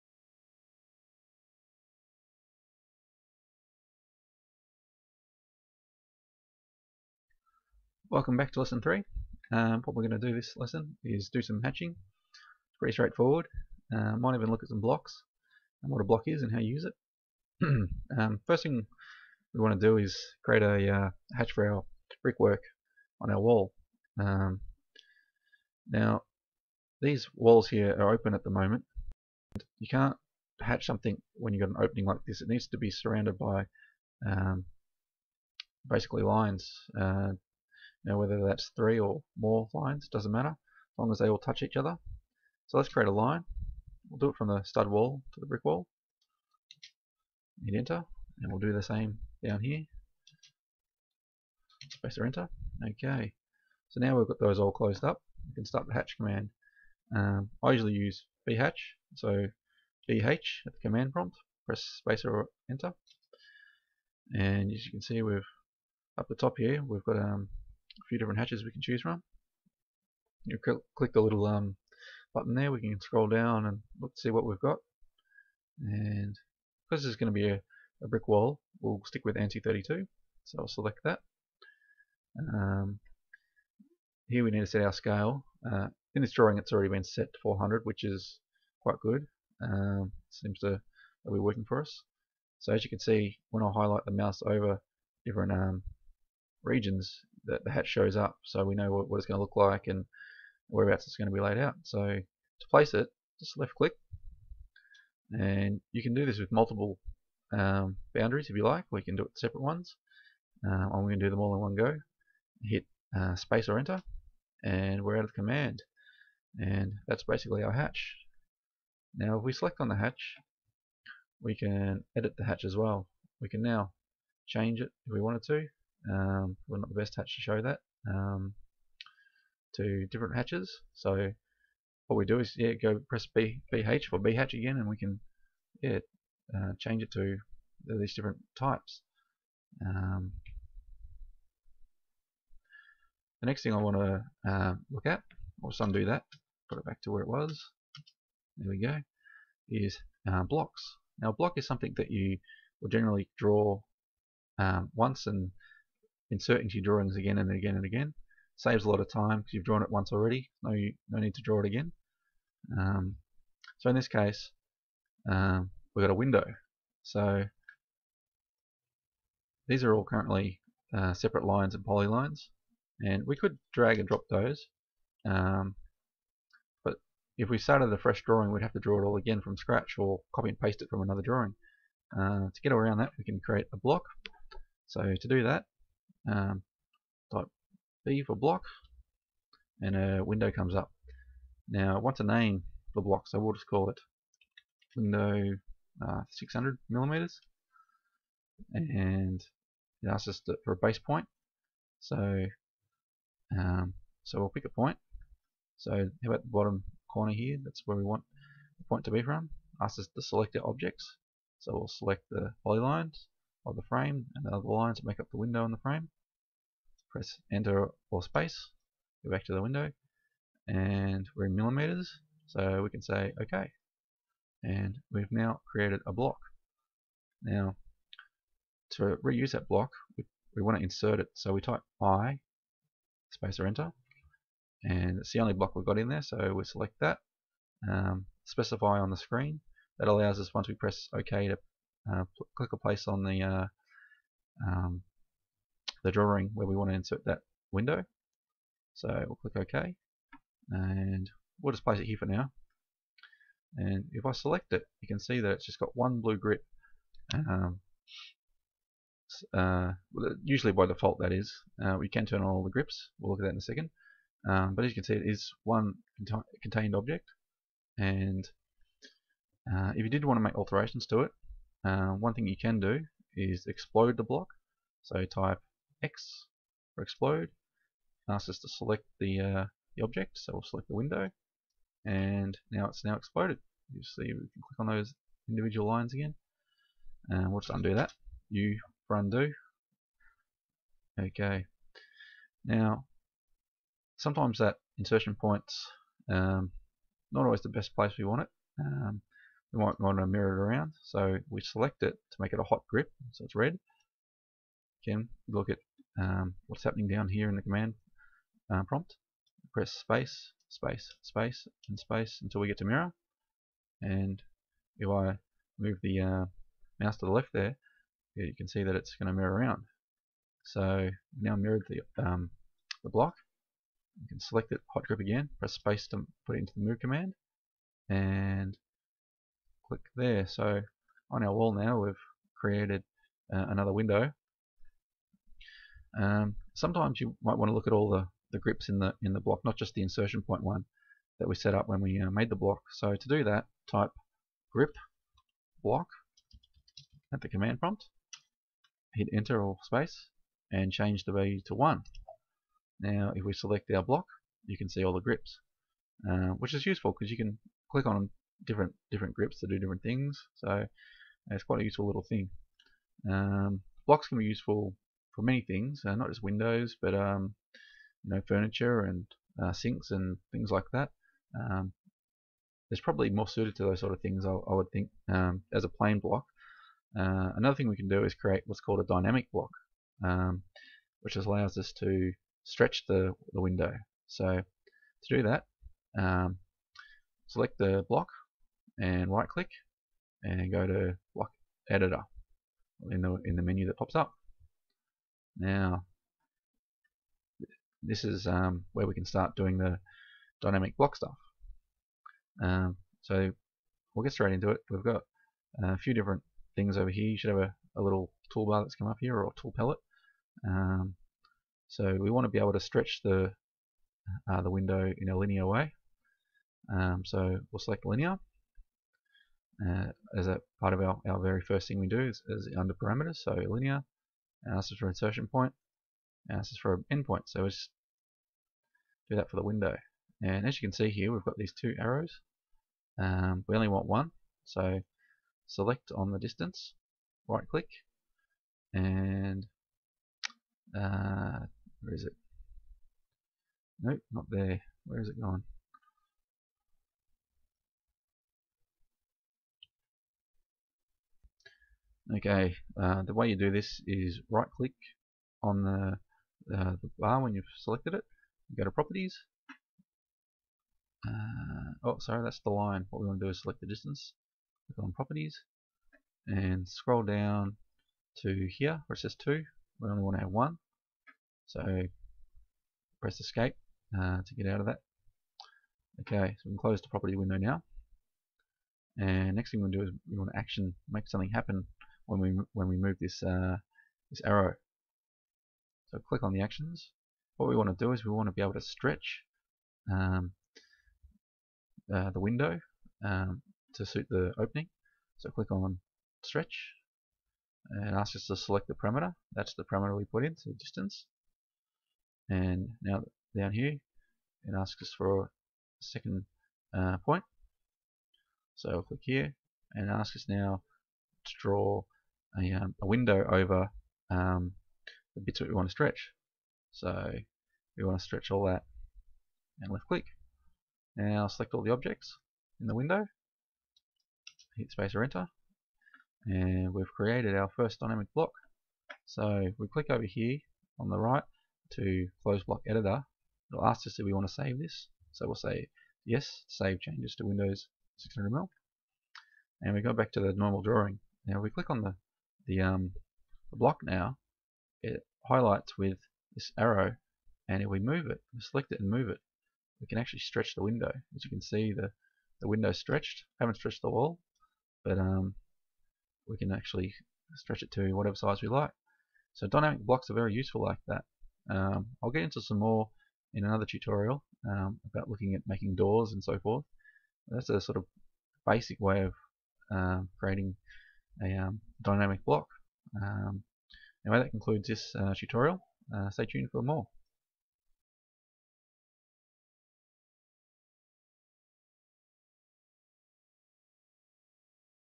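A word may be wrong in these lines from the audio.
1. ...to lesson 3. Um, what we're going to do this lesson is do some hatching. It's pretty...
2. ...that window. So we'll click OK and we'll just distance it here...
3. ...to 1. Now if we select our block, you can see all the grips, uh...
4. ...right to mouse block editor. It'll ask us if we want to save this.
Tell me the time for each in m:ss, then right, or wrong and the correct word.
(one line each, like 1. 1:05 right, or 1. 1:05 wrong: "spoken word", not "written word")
1. 0:08 right
2. 4:07 wrong: "place", not "distance"
3. 5:51 right
4. 8:51 wrong: "close", not "mouse".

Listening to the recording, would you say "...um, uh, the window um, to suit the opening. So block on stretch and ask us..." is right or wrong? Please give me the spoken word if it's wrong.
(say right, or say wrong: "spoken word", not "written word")
wrong: "click", not "block".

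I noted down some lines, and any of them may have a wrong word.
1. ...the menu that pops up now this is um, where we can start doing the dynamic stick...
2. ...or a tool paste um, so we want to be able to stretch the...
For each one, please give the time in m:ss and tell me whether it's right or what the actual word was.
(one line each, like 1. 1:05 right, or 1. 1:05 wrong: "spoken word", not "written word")
1. 6:33 wrong: "block", not "stick"
2. 6:49 wrong: "palette", not "paste".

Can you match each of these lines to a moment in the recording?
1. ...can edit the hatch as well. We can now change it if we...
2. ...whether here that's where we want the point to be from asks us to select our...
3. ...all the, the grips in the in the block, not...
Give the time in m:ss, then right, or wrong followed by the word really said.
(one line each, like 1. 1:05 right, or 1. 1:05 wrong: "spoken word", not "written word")
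1. 2:01 right
2. 3:27 wrong: "corner", not "whether"
3. 5:37 right.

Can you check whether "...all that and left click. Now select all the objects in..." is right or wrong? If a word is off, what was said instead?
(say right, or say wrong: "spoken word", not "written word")
right.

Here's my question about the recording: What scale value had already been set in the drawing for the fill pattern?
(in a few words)
400.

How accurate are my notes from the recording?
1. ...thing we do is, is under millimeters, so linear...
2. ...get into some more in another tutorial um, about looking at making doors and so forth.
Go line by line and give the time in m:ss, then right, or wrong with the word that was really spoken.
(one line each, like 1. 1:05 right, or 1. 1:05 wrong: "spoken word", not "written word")
1. 7:01 wrong: "parameters", not "millimeters"
2. 9:22 right.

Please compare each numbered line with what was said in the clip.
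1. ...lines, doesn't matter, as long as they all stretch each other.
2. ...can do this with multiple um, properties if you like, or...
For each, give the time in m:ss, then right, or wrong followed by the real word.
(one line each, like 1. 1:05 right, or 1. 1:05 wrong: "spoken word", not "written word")
1. 0:39 wrong: "touch", not "stretch"
2. 1:46 wrong: "boundaries", not "properties".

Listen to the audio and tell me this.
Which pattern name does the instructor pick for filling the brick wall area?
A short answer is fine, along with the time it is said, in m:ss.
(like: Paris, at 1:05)
ANSI32, at 1:19.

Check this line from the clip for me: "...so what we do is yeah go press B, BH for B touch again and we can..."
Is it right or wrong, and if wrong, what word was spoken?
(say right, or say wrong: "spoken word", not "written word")
wrong: "hatch", not "touch".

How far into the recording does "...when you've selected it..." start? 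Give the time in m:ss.
7:37.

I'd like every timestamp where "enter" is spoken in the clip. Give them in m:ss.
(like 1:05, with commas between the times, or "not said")
0:47, 0:52, 1:02, 1:53, 3:37, 3:53, 5:49, 8:45.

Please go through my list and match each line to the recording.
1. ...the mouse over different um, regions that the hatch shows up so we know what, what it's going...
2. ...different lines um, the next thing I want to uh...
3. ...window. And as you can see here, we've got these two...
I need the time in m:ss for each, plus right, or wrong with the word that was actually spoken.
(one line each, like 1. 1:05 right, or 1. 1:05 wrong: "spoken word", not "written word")
1. 1:34 right
2. 2:18 wrong: "types", not "lines"
3. 7:09 right.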